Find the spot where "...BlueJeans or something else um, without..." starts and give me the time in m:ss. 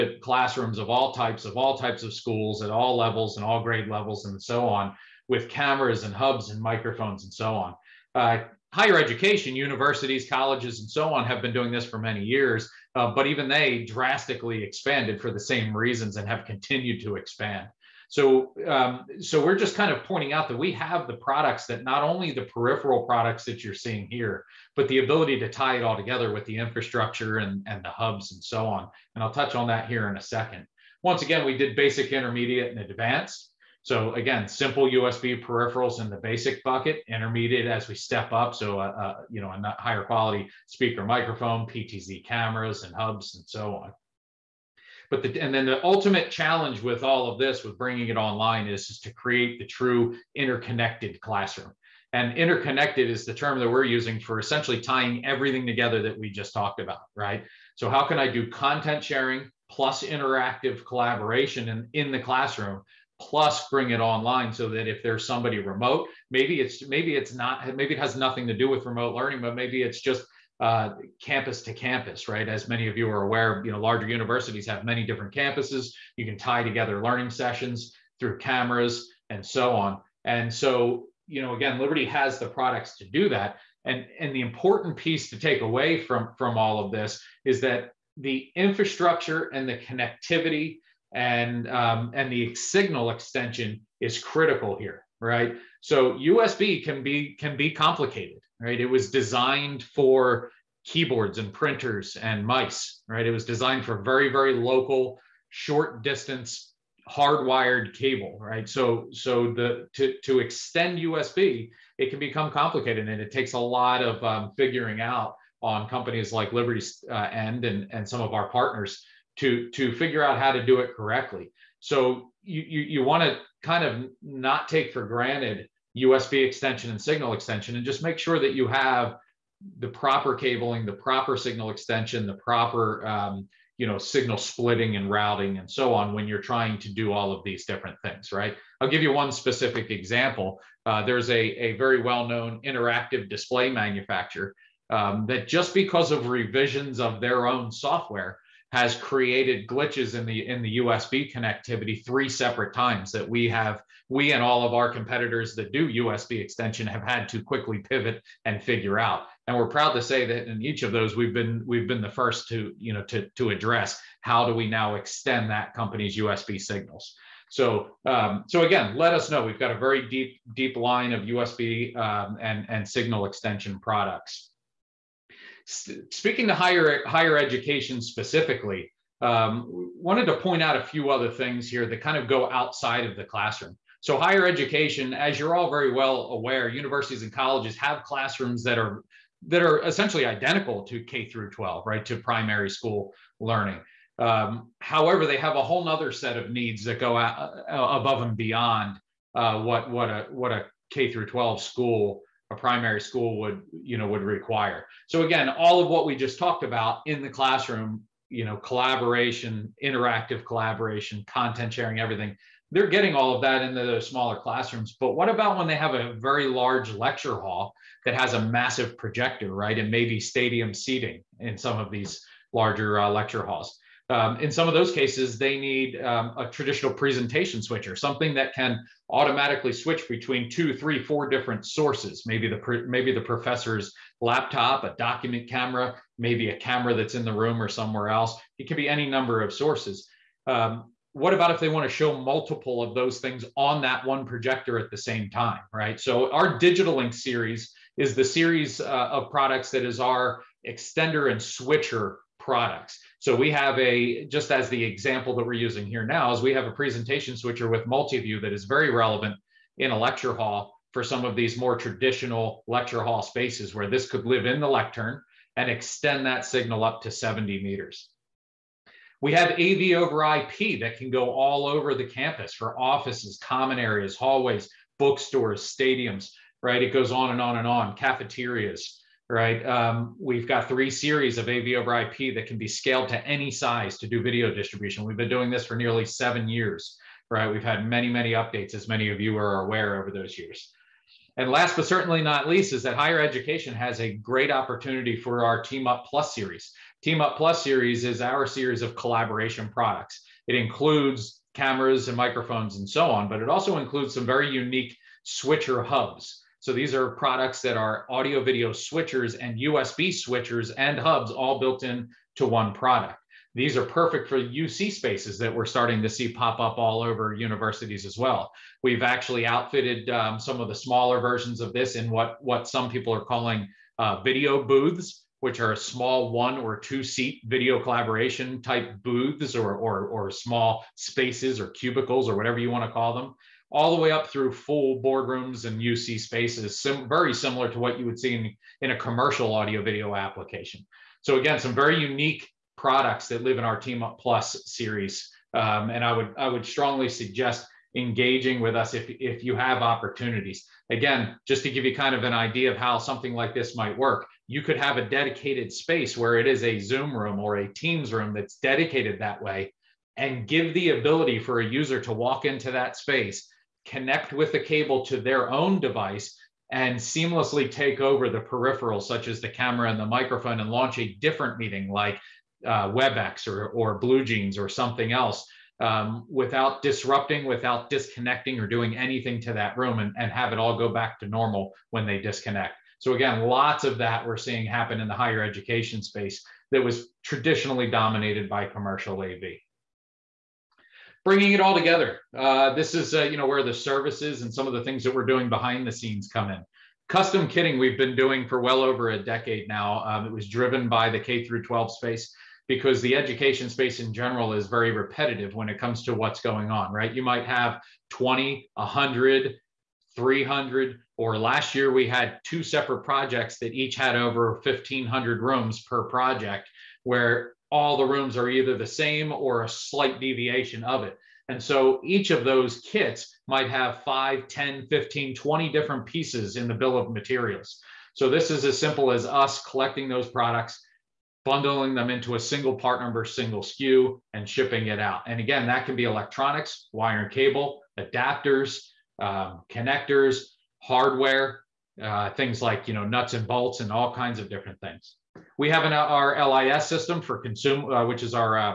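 6:13.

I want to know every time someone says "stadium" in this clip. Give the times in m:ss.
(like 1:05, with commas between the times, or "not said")
3:40, 4:35.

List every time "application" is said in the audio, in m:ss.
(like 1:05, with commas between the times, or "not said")
5:40.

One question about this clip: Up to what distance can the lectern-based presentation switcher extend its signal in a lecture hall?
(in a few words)
70 meters.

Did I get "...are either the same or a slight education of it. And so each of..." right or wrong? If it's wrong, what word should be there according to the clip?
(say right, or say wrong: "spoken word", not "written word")
wrong: "deviation", not "education".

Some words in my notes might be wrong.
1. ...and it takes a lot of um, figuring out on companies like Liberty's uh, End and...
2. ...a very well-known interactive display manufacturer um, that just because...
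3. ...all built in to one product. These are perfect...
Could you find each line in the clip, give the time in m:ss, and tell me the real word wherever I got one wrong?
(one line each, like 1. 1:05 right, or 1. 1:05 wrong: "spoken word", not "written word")
1. 1:53 right
2. 2:21 right
3. 5:11 right.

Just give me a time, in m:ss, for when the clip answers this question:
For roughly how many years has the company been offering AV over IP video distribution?
4:46.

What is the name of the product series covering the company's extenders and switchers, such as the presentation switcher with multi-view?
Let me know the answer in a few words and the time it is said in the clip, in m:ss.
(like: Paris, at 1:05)
DigitaLinx, at 4:06.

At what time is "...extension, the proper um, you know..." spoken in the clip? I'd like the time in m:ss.
2:11.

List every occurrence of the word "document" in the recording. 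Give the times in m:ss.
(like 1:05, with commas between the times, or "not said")
3:54.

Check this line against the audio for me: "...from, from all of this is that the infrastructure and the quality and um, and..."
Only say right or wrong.
wrong.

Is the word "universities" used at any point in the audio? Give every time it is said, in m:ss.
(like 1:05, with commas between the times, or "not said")
0:09, 1:14, 3:06, 5:17.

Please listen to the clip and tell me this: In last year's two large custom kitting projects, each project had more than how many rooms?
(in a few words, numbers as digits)
1,500.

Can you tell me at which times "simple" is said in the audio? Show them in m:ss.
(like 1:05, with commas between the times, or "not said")
0:34, 7:08.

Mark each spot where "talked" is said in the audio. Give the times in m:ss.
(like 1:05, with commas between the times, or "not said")
0:56, 3:26.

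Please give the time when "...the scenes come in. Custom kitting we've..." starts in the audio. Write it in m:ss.
6:35.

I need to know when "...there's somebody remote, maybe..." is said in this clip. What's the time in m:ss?
1:05.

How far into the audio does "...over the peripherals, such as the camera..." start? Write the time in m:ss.
6:07.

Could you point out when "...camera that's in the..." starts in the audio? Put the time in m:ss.
3:56.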